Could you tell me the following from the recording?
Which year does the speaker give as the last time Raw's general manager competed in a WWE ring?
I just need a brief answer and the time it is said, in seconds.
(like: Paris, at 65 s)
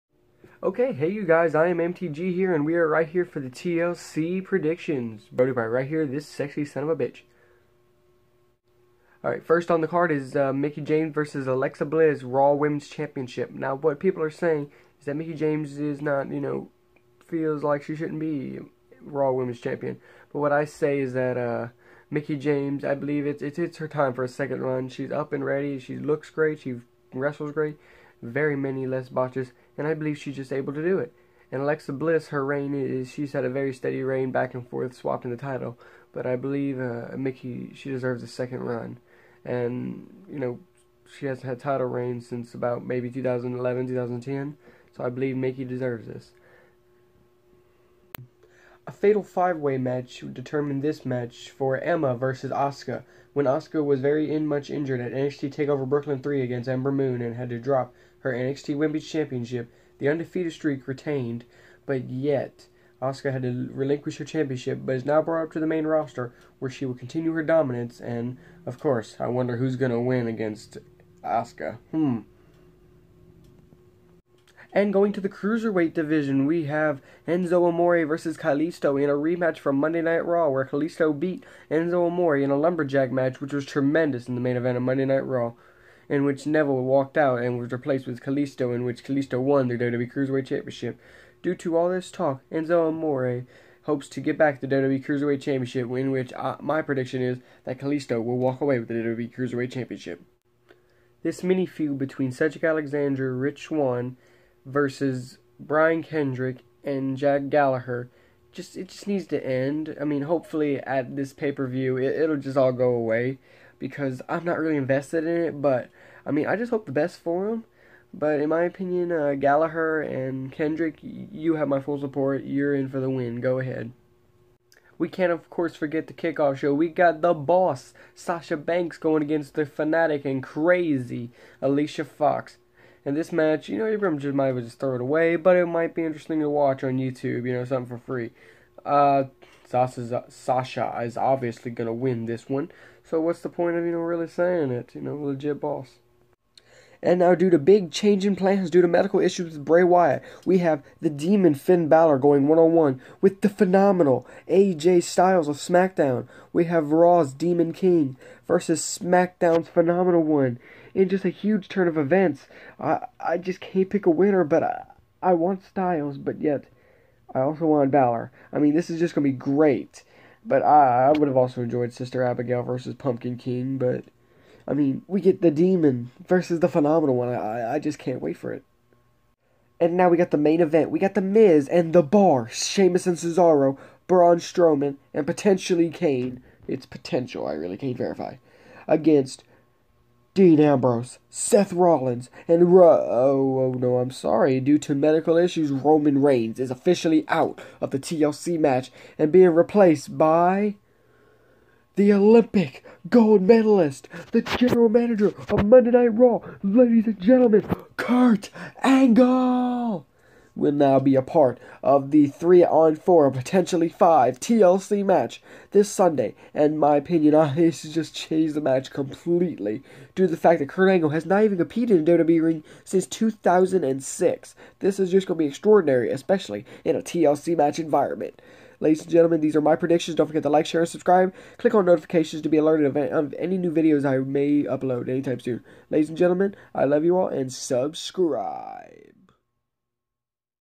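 2006, at 223 s.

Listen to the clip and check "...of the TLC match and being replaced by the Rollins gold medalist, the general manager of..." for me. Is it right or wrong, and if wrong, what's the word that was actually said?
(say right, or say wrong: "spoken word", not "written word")
wrong: "Olympic", not "Rollins".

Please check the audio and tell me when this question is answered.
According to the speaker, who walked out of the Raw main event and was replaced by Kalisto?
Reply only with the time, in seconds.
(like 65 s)
86 s.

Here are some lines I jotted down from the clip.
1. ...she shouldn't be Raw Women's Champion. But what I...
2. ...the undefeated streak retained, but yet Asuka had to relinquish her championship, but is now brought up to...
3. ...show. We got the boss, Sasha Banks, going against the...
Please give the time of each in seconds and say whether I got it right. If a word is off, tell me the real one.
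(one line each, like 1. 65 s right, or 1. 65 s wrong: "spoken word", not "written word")
1. 17 s right
2. 59 s right
3. 126 s right.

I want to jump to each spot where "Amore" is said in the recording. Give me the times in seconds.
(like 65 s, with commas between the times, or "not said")
77 s, 82 s, 92 s.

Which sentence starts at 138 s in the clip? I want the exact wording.
Uh, Sasha is obviously going to win this one.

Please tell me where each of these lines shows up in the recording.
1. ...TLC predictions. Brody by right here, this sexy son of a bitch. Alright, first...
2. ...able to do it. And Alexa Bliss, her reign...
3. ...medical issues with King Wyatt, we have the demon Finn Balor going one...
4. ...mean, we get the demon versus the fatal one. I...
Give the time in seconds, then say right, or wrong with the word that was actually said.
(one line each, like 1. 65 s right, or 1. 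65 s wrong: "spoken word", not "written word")
1. 3 s right
2. 30 s right
3. 148 s wrong: "Bray", not "King"
4. 174 s wrong: "phenomenal", not "fatal".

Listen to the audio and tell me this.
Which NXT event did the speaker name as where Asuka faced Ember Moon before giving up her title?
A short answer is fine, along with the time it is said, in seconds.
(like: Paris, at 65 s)
NXT Takeover Brooklyn 3, at 55 s.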